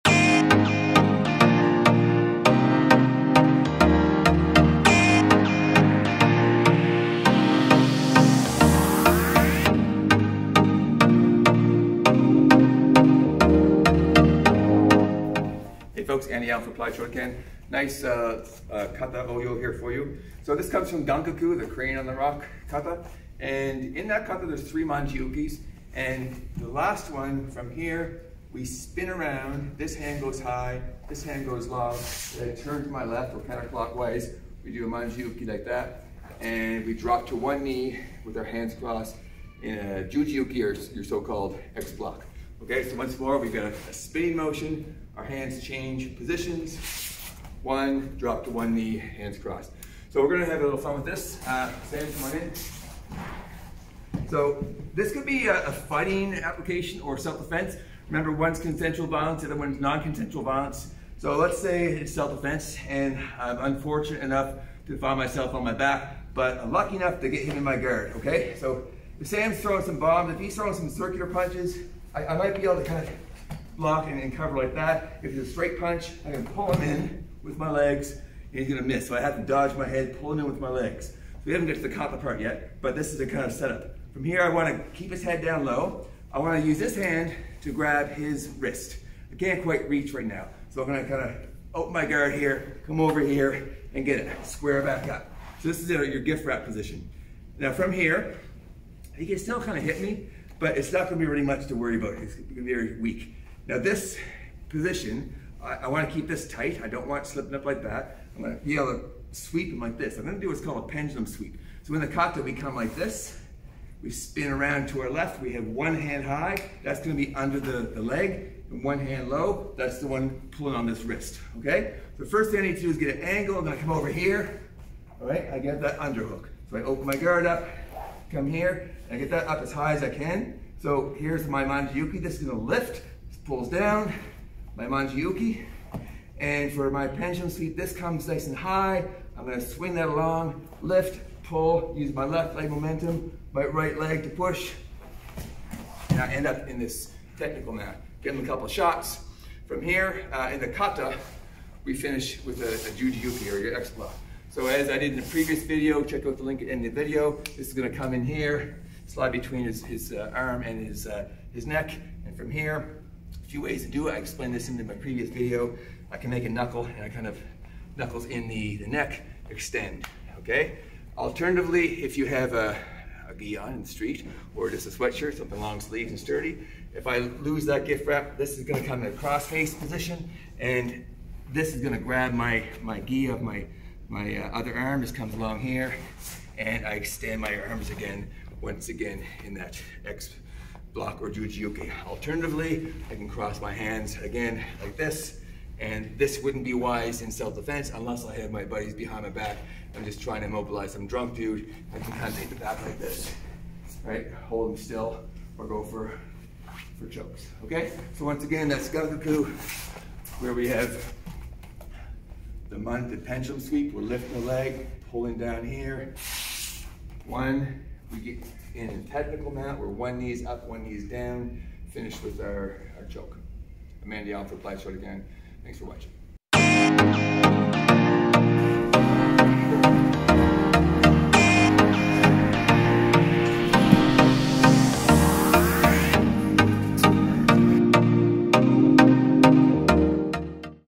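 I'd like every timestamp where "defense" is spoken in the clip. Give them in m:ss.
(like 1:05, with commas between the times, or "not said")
0:57, 1:02, 3:17.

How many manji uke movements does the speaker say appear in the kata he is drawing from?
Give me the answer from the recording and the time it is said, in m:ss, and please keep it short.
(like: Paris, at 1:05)
3, at 0:24.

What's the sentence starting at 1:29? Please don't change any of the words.
I can't quite reach right now.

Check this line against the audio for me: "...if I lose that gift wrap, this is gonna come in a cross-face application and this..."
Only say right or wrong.
wrong.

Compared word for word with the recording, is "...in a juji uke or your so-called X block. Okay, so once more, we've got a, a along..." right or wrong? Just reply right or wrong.
wrong.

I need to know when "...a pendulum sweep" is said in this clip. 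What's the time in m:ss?
1:50.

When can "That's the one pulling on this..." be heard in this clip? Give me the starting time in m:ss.
1:59.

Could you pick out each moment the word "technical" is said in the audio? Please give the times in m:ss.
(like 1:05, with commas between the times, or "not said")
2:27, 3:39.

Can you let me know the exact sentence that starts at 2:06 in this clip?
So I open my guard up, come here, I get that up as high as I can.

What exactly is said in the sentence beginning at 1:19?
So I have to dodge my head, pull him in with my legs.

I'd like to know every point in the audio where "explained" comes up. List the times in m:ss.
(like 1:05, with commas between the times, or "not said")
2:44.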